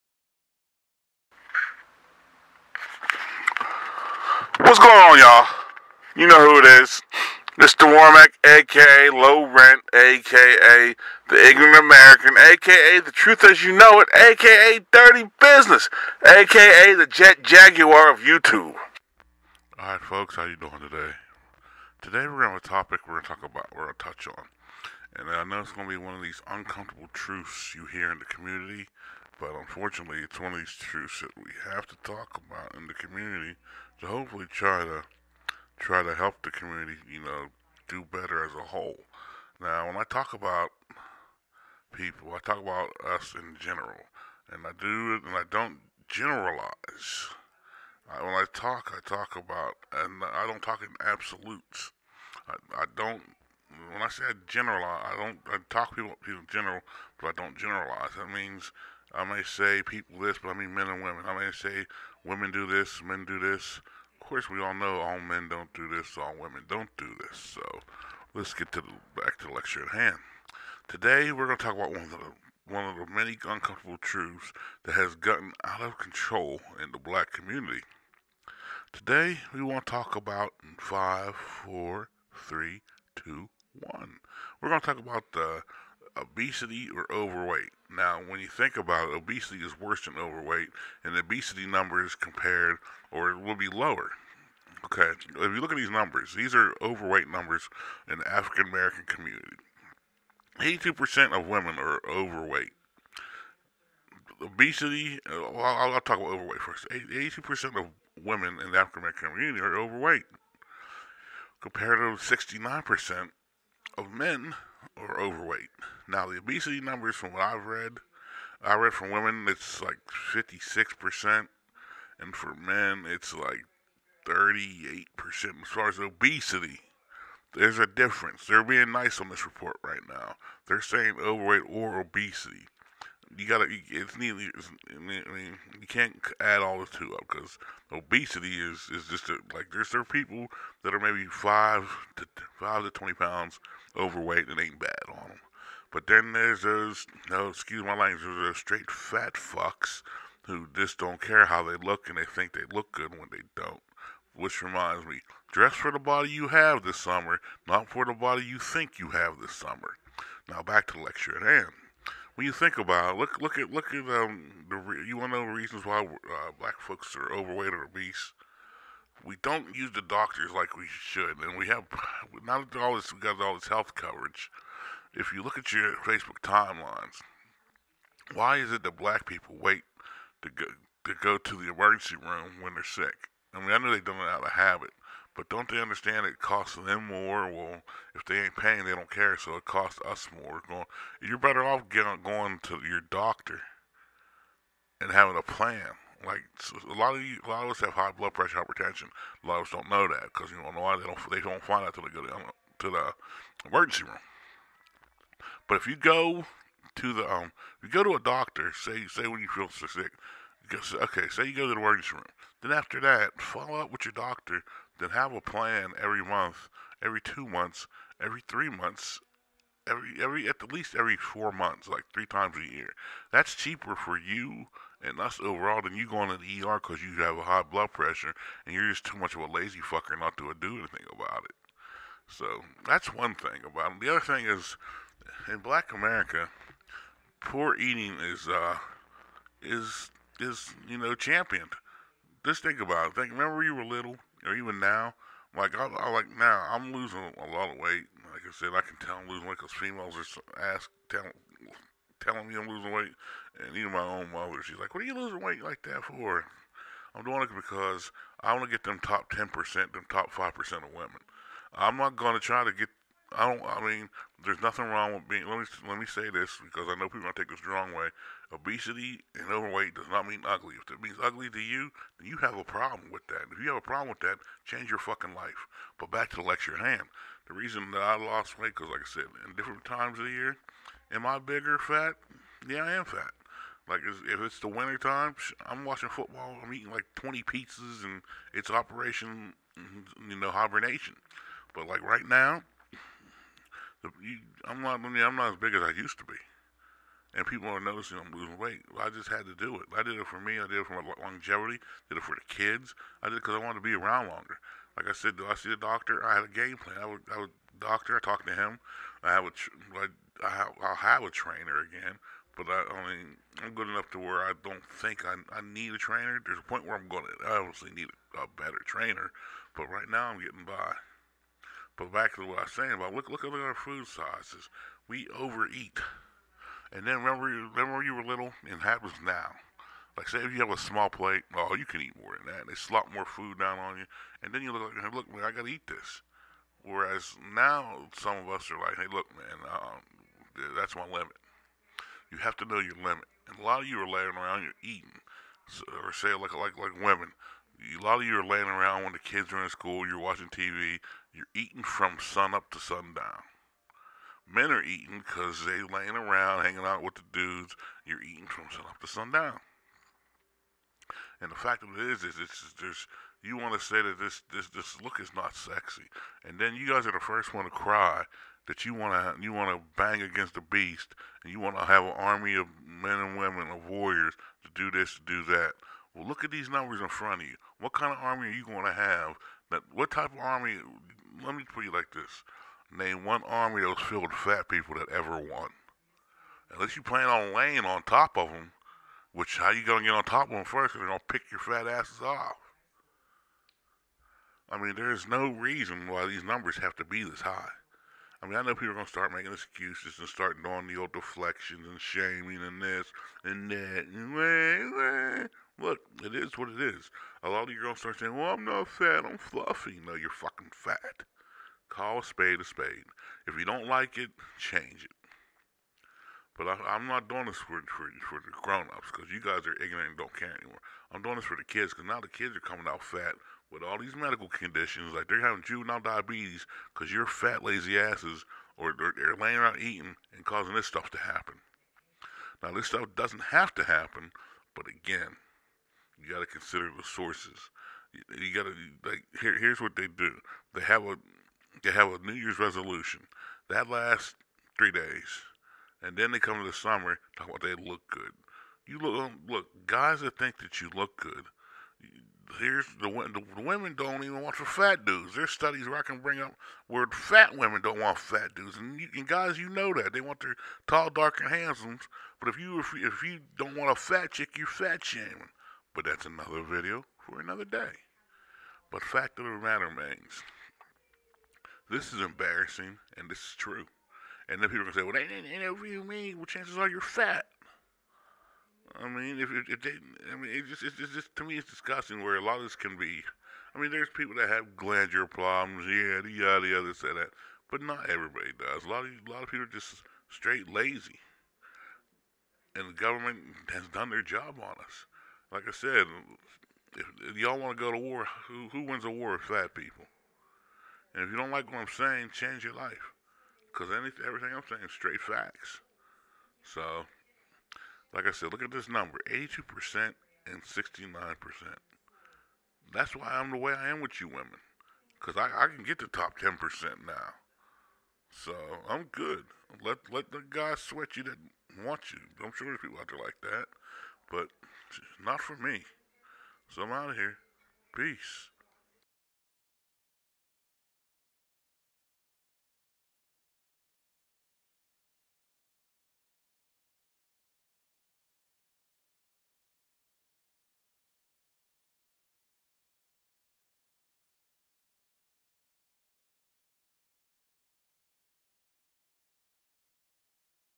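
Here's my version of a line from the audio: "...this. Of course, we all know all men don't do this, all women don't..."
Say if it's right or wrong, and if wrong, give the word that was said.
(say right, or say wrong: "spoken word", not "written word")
right.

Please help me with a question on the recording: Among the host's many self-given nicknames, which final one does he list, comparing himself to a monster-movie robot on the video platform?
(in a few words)
The Jet Jaguar of YouTube.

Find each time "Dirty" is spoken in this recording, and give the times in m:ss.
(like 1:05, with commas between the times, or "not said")
0:14.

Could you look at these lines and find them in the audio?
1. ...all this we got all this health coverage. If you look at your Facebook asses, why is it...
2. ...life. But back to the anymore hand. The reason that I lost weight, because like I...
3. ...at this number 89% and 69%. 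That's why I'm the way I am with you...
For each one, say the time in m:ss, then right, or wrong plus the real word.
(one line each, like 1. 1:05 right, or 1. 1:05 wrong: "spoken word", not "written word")
1. 2:52 wrong: "timelines", not "asses"
2. 4:35 wrong: "lecture", not "anymore"
3. 8:28 wrong: "82", not "89".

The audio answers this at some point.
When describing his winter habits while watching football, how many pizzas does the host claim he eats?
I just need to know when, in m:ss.
4:47.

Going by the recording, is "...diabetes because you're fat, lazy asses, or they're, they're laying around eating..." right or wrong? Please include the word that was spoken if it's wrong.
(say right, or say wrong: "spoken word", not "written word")
right.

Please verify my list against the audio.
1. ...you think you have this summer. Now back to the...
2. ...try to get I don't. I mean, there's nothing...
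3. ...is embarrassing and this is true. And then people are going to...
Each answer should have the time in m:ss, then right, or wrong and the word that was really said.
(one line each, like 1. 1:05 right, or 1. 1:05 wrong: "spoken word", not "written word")
1. 2:38 right
2. 4:22 right
3. 7:52 right.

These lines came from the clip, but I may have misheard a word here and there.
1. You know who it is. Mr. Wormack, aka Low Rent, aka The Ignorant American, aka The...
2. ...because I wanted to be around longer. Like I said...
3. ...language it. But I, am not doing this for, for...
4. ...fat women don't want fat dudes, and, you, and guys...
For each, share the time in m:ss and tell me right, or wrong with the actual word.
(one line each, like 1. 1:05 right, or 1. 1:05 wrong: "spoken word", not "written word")
1. 0:06 right
2. 5:03 right
3. 6:54 wrong: "change", not "language"
4. 7:37 right.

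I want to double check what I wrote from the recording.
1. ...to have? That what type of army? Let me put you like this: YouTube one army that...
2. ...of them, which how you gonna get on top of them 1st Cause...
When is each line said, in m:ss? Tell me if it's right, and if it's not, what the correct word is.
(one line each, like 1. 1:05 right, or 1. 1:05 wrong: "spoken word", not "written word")
1. 6:18 wrong: "Name", not "YouTube"
2. 6:28 right.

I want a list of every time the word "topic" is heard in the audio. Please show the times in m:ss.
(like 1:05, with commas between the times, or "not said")
0:22.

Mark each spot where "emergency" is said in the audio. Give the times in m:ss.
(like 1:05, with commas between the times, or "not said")
3:01, 3:23, 3:31.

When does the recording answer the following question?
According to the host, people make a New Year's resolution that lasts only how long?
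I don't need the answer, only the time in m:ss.
7:24.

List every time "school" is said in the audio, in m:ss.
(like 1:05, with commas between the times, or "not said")
5:49.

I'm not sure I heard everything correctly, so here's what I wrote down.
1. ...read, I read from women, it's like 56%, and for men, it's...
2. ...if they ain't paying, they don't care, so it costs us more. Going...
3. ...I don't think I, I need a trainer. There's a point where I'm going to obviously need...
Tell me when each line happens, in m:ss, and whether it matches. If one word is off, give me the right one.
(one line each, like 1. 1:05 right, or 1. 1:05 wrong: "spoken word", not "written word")
1. 1:57 right
2. 3:08 right
3. 5:14 right.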